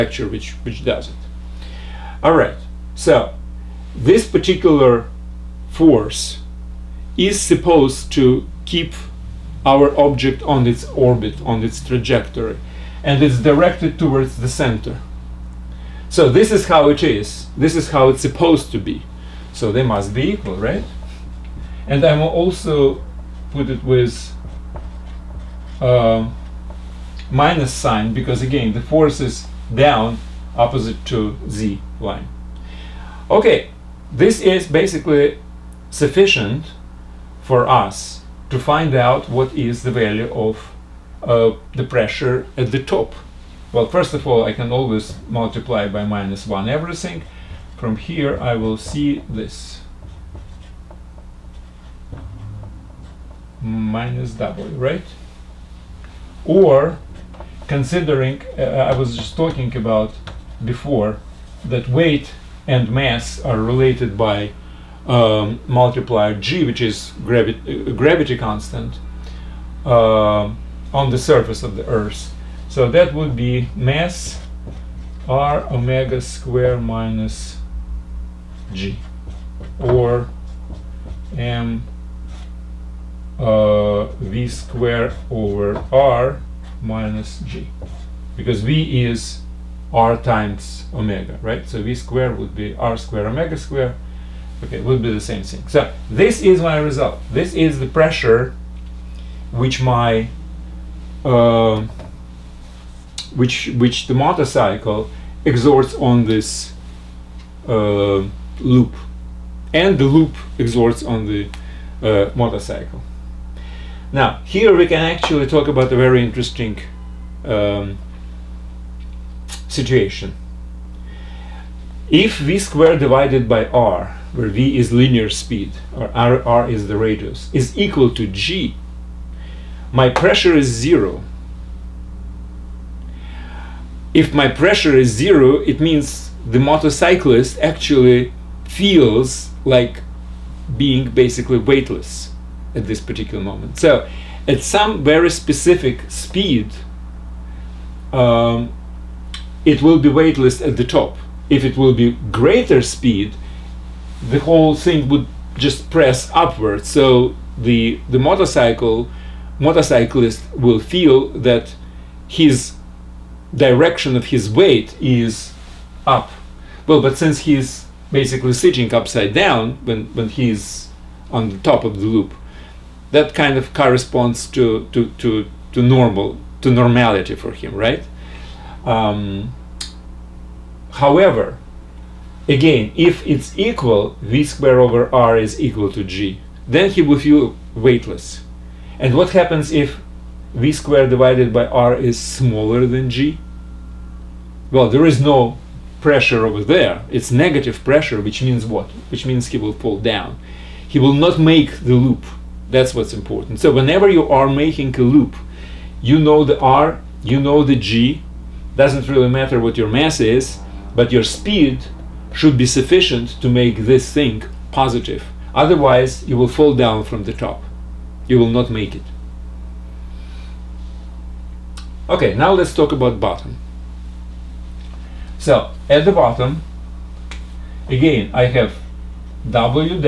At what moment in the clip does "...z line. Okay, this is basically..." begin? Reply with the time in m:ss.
0:31.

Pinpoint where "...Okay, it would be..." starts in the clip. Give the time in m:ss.
1:34.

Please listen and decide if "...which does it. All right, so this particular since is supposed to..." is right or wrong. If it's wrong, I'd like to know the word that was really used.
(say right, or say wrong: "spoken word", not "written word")
wrong: "force", not "since".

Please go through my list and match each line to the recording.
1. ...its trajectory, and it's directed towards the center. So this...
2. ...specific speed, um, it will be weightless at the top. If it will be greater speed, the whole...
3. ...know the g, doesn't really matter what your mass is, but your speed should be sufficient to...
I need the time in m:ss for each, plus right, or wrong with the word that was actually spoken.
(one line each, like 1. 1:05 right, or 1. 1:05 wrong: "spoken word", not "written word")
1. 0:11 right
2. 2:25 right
3. 3:27 right.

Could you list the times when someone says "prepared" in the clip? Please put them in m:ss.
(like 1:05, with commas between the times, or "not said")
not said.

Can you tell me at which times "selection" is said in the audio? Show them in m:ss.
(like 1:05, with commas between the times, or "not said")
not said.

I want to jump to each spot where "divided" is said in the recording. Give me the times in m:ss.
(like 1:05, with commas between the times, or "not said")
2:02, 3:11.